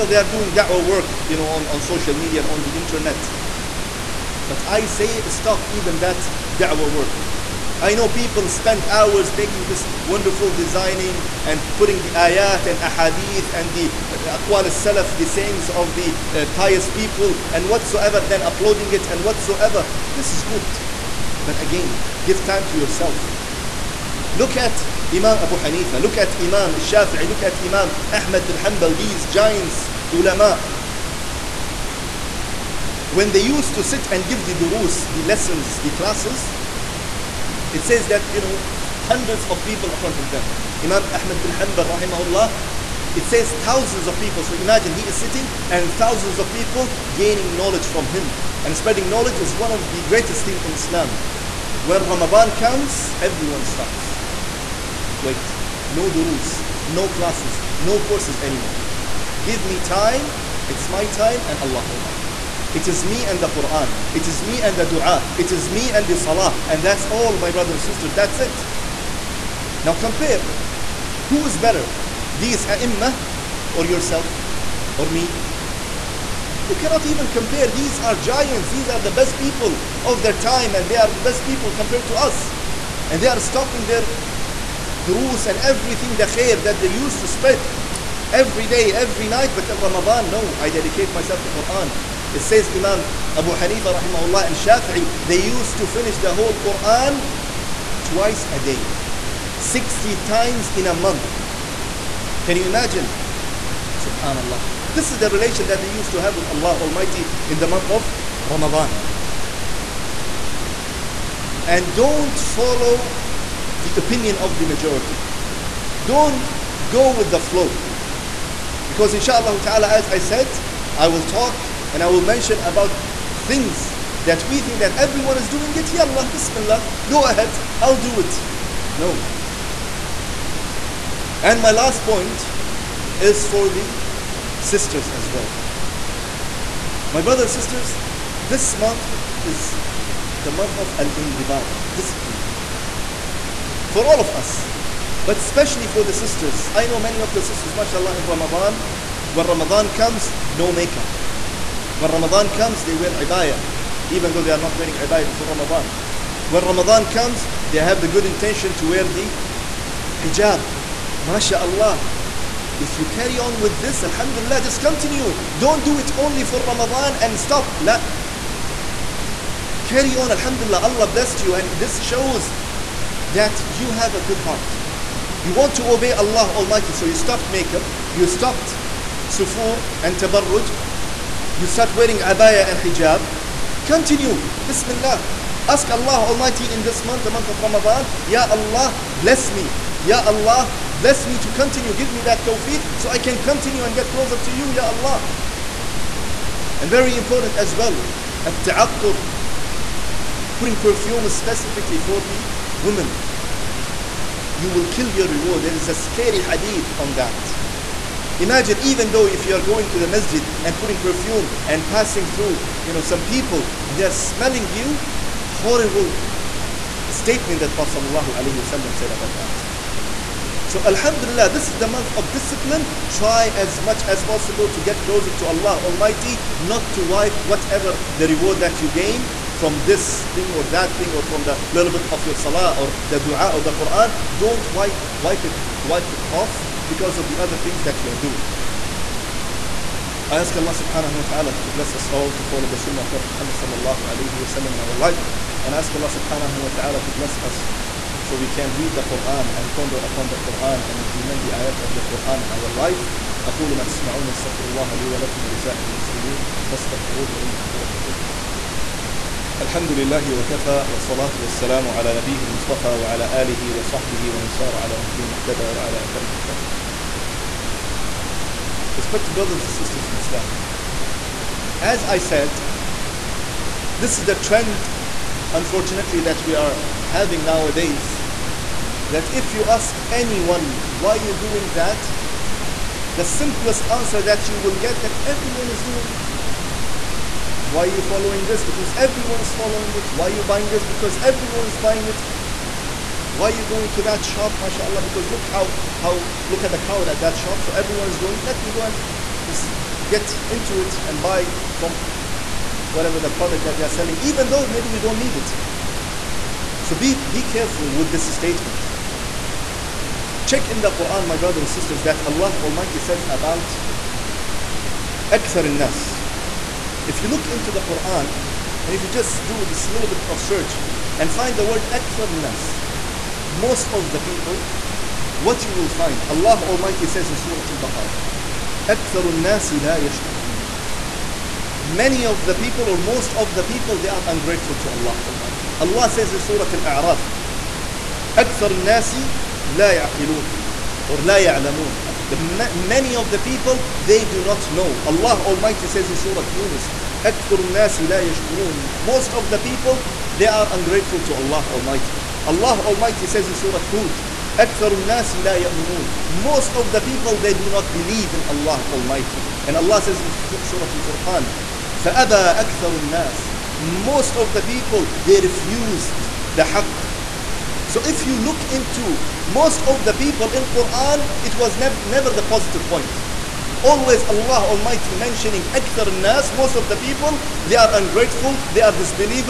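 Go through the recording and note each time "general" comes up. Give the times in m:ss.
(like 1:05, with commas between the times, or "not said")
not said.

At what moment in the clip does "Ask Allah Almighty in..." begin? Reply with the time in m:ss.
3:05.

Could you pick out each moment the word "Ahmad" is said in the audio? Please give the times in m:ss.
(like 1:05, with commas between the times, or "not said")
0:28, 0:41.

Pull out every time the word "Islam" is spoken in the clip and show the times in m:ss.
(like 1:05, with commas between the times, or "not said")
0:50, 4:30.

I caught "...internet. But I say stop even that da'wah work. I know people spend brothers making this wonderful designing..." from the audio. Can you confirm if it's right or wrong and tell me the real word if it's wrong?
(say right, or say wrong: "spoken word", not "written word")
wrong: "hours", not "brothers".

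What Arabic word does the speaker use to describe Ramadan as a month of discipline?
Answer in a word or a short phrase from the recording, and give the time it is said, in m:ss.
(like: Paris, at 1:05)
al-indibat, at 2:20.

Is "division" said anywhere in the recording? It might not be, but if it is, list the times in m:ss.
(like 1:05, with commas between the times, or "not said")
not said.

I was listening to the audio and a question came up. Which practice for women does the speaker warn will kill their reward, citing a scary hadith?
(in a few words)
at-ta'attur (putting perfume).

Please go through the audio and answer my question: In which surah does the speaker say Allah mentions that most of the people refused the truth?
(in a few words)
Surah Al-Furqan.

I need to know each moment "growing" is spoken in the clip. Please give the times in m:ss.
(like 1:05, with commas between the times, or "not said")
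not said.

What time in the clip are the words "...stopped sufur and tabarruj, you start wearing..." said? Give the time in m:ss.
2:58.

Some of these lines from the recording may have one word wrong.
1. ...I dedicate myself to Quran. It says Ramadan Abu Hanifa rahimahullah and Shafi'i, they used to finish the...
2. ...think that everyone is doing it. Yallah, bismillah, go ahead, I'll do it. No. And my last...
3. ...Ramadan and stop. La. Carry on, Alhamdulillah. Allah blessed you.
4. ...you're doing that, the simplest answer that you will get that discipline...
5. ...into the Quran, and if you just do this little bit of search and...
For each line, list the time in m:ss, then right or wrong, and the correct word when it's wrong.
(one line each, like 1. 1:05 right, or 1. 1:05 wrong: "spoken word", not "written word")
1. 1:30 wrong: "Imam", not "Ramadan"
2. 2:04 right
3. 2:46 right
4. 4:41 wrong: "everyone", not "discipline"
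5. 5:17 right.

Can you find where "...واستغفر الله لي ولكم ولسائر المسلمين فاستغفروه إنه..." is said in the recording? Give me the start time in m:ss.
4:14.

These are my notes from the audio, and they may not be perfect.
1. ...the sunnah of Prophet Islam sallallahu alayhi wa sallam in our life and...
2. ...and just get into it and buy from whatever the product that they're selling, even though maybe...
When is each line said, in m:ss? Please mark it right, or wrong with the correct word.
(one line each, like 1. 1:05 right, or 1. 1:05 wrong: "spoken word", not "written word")
1. 4:02 wrong: "Muhammad", not "Islam"
2. 4:58 right.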